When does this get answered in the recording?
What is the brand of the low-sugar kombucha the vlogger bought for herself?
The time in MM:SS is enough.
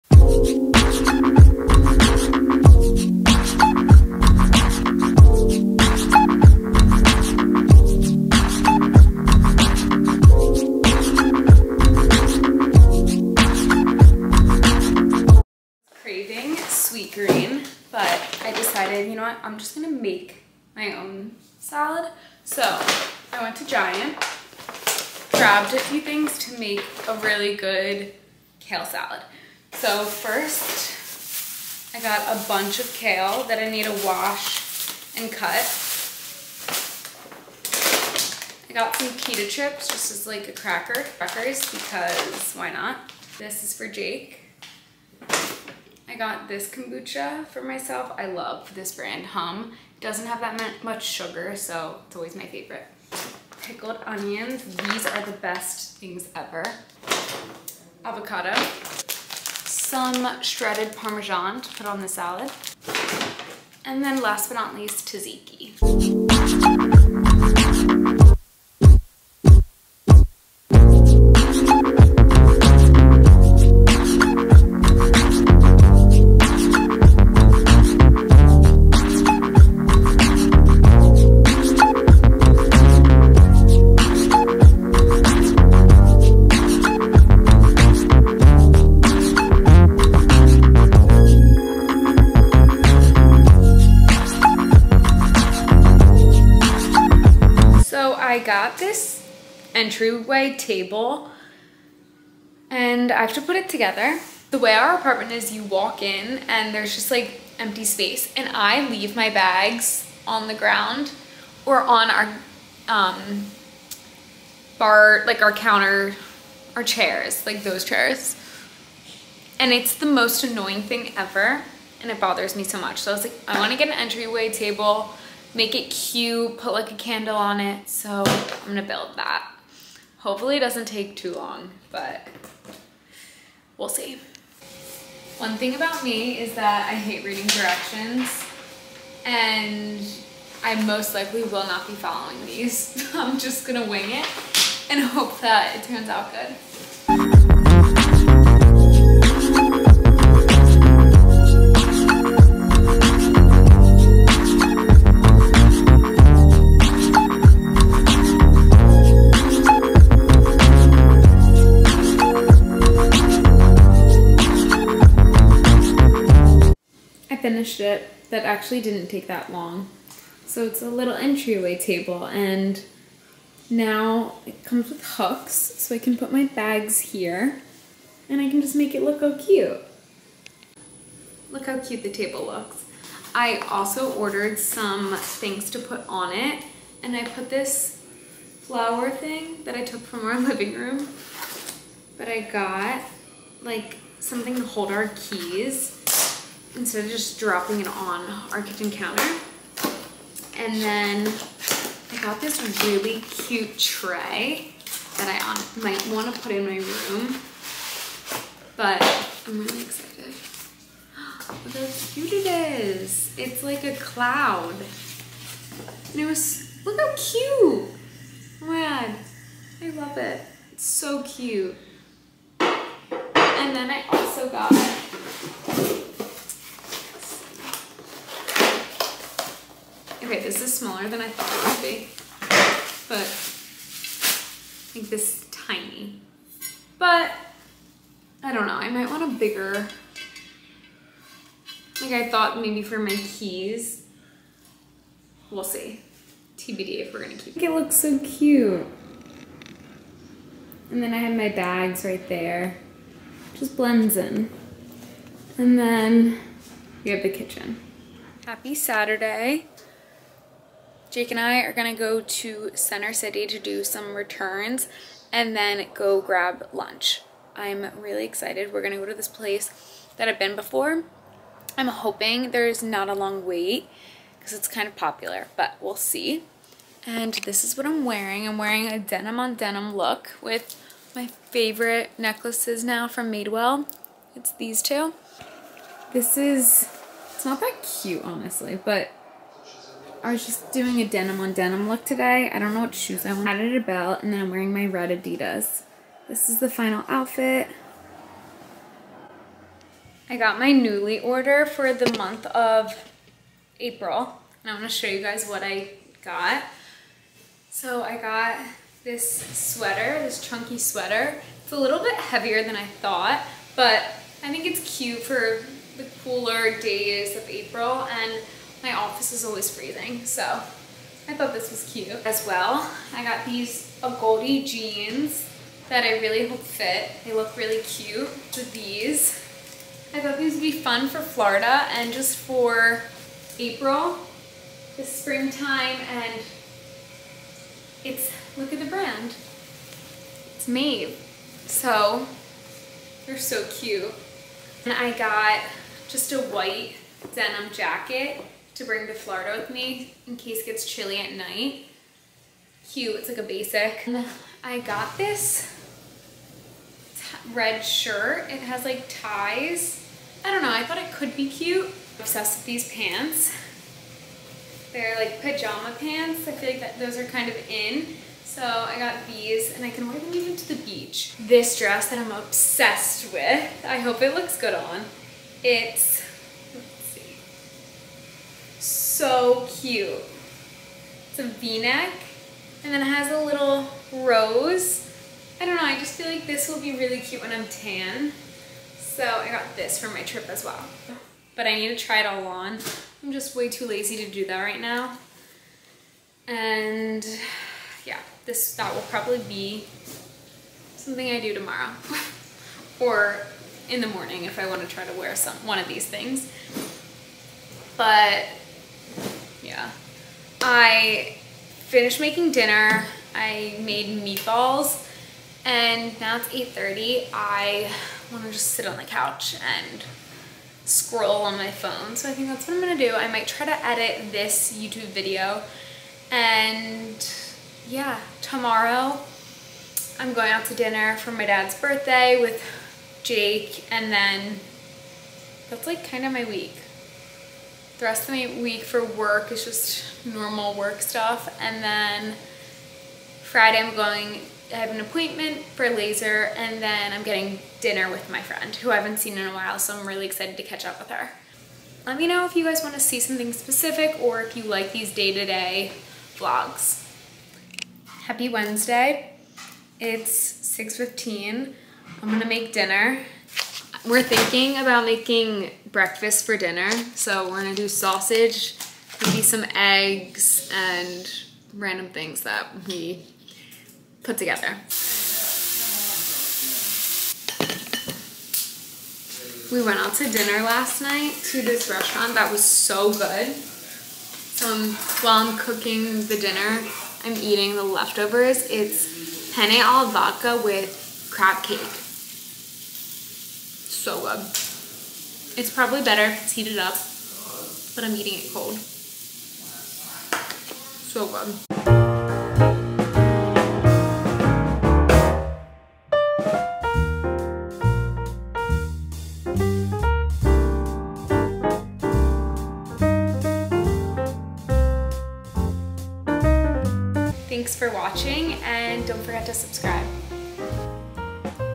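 00:49.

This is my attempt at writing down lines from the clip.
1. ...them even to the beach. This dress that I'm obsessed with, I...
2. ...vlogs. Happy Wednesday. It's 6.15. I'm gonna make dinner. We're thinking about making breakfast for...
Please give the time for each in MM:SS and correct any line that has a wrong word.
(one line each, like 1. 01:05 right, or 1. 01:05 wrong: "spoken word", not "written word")
1. 06:10 right
2. 07:36 right.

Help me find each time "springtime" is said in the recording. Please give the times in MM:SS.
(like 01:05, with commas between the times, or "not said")
05:35.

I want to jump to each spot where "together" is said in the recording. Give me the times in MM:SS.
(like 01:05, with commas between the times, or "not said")
01:43, 07:54.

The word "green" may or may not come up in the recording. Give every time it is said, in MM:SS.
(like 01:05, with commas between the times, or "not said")
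00:17.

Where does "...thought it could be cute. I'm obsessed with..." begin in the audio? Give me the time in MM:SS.
06:00.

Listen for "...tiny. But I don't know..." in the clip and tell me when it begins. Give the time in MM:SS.
03:55.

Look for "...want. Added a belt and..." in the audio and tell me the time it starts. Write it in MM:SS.
04:53.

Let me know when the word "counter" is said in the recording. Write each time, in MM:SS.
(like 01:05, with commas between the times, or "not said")
01:55, 03:18.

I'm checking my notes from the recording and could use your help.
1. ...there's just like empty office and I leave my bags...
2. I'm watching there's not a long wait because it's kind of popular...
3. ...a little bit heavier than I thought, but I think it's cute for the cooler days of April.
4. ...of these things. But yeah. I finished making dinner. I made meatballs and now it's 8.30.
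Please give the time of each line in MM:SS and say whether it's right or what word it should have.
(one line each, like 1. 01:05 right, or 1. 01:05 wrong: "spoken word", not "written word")
1. 01:46 wrong: "space", not "office"
2. 04:31 wrong: "hoping", not "watching"
3. 05:11 right
4. 06:45 right.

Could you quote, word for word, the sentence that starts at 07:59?
We went out to dinner last night to this restaurant that was so good.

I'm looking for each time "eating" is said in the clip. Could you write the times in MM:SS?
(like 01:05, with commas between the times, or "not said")
08:07, 08:18.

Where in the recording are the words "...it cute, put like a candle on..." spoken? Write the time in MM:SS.
02:05.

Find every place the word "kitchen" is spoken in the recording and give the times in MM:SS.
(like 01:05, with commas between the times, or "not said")
03:18, 04:17.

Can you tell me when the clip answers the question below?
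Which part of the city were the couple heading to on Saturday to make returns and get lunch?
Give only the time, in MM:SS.
04:22.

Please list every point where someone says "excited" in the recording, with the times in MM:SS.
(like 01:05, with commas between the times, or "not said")
03:29, 04:28, 07:30.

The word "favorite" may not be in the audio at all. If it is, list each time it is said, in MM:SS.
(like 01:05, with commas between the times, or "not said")
00:52, 04:41.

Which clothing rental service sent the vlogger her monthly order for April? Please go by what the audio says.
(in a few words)
Nuuly.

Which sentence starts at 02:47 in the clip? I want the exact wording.
finished it that actually didn't take that long.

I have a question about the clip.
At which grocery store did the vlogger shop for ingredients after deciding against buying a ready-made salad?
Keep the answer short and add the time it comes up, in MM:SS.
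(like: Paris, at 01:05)
Giant, at 00:23.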